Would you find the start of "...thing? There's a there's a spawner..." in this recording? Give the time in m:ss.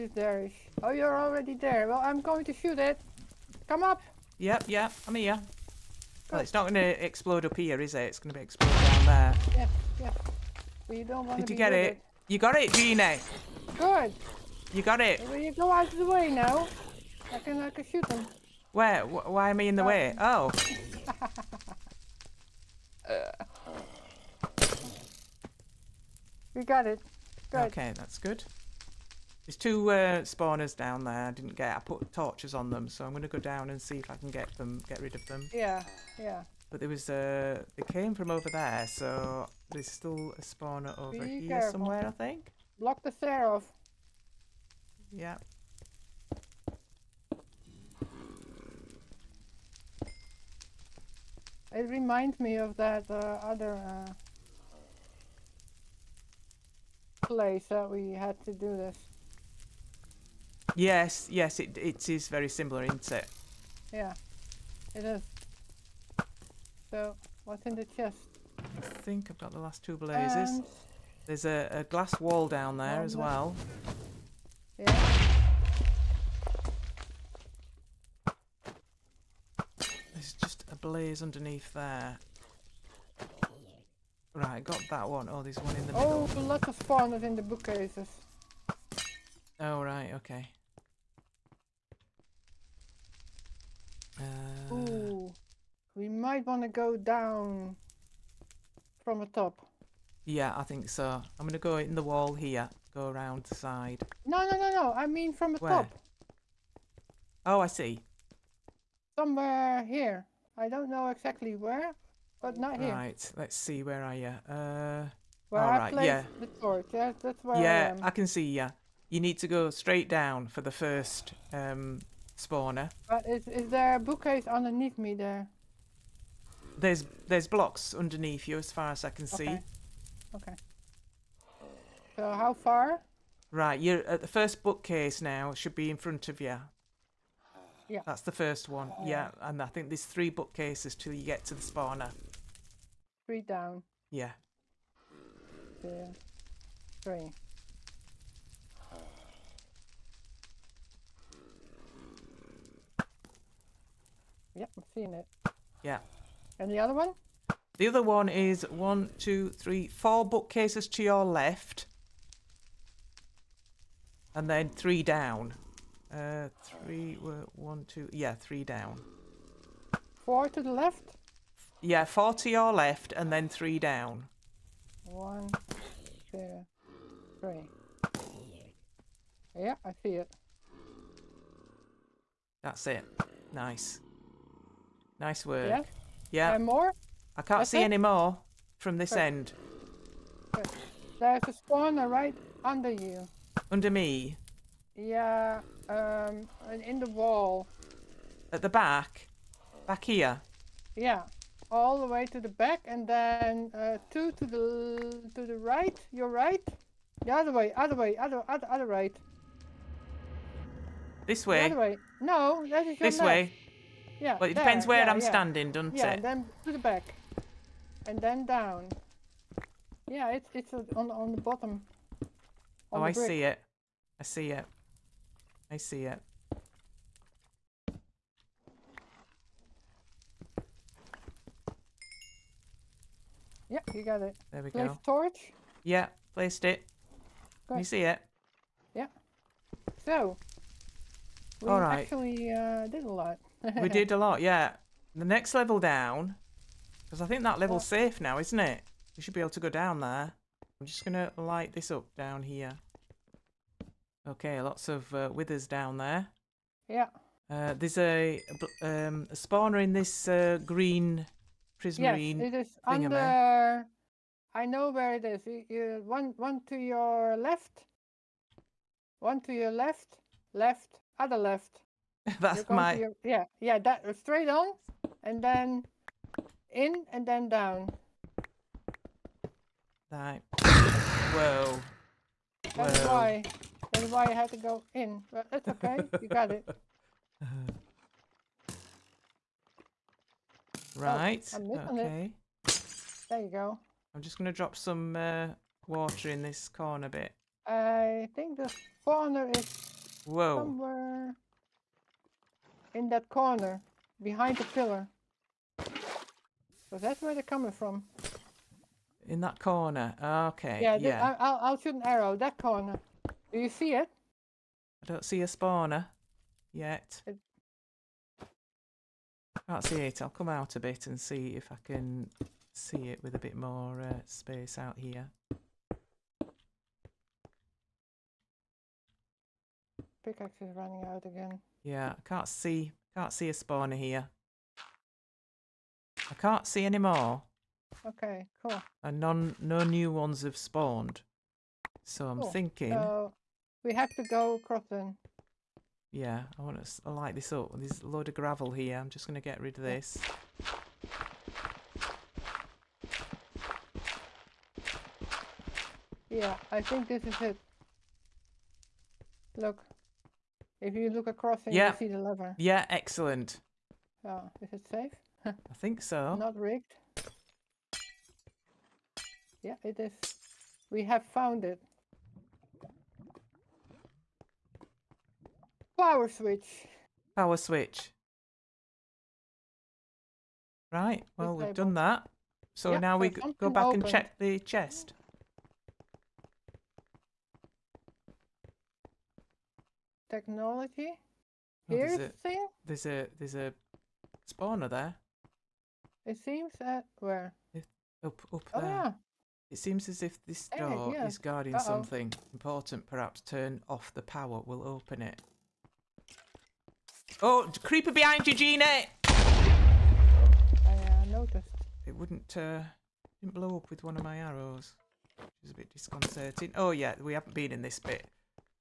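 6:32.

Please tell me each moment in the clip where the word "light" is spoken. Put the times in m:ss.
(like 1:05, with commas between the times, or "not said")
4:11, 5:47.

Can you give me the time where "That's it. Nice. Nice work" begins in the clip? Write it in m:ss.
3:02.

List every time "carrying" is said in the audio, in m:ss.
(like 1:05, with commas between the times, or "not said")
not said.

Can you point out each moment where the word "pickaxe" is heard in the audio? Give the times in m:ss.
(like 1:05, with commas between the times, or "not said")
5:30.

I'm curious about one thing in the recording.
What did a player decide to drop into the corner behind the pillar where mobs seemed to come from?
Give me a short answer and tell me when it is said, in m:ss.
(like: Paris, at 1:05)
Water, at 4:54.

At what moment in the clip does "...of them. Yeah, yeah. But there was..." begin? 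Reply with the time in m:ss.
0:35.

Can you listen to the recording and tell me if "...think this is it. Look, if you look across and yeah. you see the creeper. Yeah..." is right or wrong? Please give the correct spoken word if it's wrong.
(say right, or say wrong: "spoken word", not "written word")
wrong: "lever", not "creeper".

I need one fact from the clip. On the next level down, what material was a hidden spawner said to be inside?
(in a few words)
Green prismarine.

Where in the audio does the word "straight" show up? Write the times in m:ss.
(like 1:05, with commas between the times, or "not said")
1:59, 4:34.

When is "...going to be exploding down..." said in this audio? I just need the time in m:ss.
0:08.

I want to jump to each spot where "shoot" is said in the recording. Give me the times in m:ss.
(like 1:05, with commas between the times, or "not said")
0:02, 0:17, 5:11.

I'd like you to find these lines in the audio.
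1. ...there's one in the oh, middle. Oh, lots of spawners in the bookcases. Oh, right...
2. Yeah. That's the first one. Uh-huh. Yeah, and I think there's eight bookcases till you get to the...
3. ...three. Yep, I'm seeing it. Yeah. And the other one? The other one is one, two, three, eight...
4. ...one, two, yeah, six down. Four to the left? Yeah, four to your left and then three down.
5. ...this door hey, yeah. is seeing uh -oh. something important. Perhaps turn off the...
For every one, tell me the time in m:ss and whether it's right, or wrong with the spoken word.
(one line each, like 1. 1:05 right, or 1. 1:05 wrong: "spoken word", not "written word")
1. 1:25 right
2. 2:17 wrong: "three", not "eight"
3. 2:27 wrong: "four", not "eight"
4. 2:47 wrong: "three", not "six"
5. 6:40 wrong: "guarding", not "seeing".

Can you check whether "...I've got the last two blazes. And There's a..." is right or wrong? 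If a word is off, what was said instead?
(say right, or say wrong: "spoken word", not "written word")
right.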